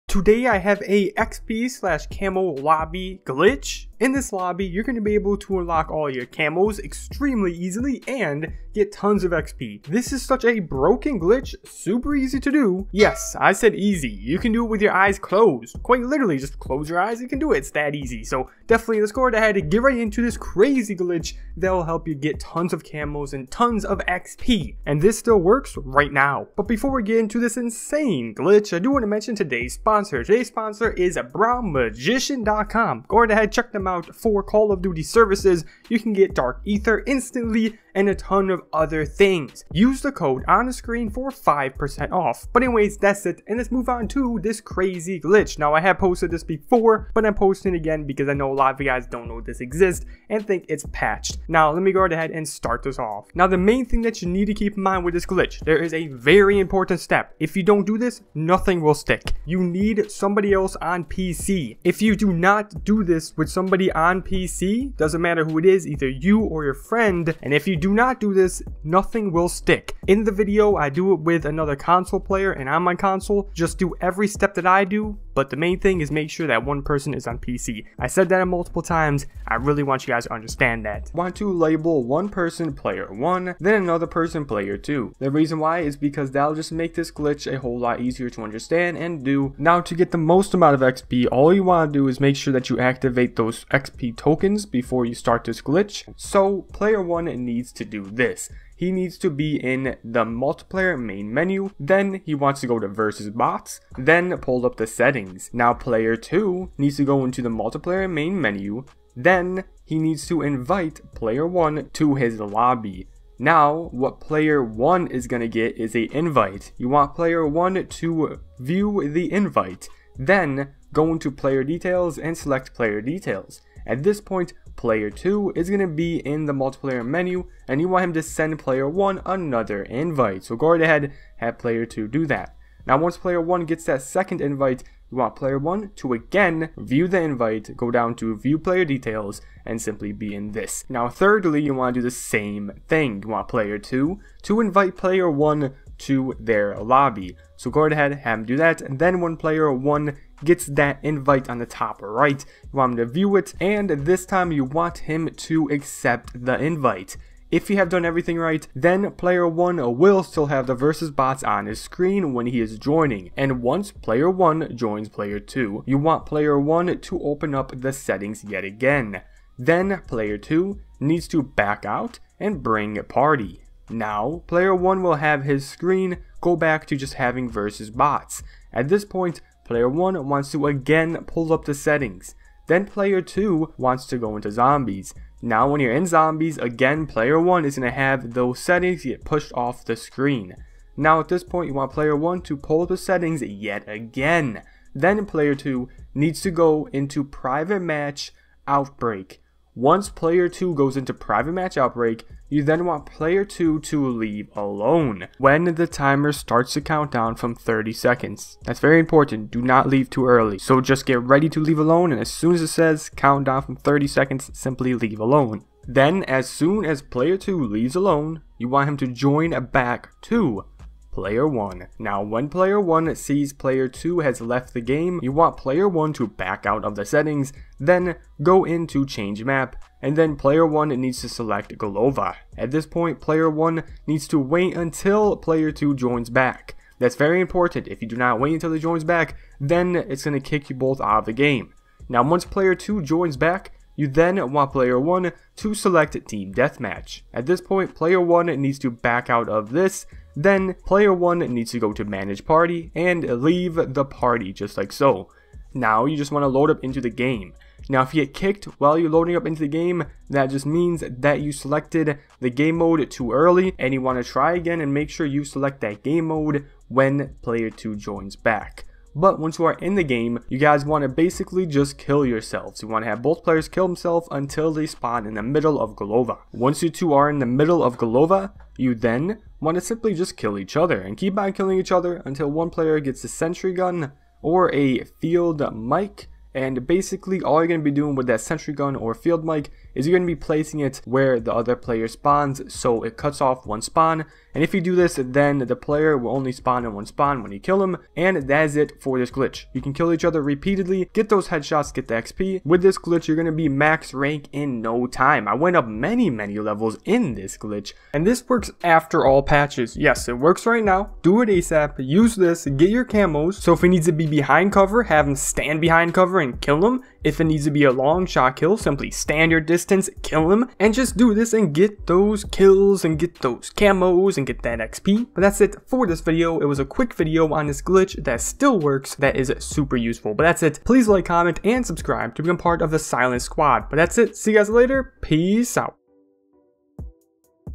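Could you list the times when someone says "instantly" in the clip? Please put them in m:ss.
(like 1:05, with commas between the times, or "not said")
0:37.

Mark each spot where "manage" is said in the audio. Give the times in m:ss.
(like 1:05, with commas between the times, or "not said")
4:12.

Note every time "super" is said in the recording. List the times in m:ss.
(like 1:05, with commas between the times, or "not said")
0:11, 5:29.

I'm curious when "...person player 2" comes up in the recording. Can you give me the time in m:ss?
1:24.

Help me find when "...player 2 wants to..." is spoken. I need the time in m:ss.
3:02.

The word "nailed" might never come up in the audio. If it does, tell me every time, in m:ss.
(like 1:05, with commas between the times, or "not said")
not said.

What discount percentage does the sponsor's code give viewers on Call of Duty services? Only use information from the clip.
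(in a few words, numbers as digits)
5%.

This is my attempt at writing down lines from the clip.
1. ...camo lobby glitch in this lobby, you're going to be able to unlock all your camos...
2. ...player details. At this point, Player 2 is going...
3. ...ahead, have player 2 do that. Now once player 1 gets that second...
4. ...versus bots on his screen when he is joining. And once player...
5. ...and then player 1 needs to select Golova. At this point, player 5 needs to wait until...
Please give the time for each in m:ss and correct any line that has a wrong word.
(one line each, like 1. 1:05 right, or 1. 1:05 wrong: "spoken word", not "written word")
1. 0:02 right
2. 2:02 right
3. 2:10 right
4. 2:40 right
5. 3:50 wrong: "1", not "5".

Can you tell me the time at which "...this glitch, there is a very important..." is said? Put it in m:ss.
0:55.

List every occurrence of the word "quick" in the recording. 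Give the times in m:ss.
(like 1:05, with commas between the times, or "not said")
5:26.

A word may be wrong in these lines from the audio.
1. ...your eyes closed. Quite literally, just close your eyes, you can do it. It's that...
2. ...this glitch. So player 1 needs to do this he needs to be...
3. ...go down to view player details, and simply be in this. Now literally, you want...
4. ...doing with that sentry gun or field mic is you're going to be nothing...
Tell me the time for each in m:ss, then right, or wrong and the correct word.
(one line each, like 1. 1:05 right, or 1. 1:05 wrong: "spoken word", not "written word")
1. 0:14 right
2. 1:35 right
3. 2:17 wrong: "thirdly", not "literally"
4. 4:47 wrong: "placing", not "nothing".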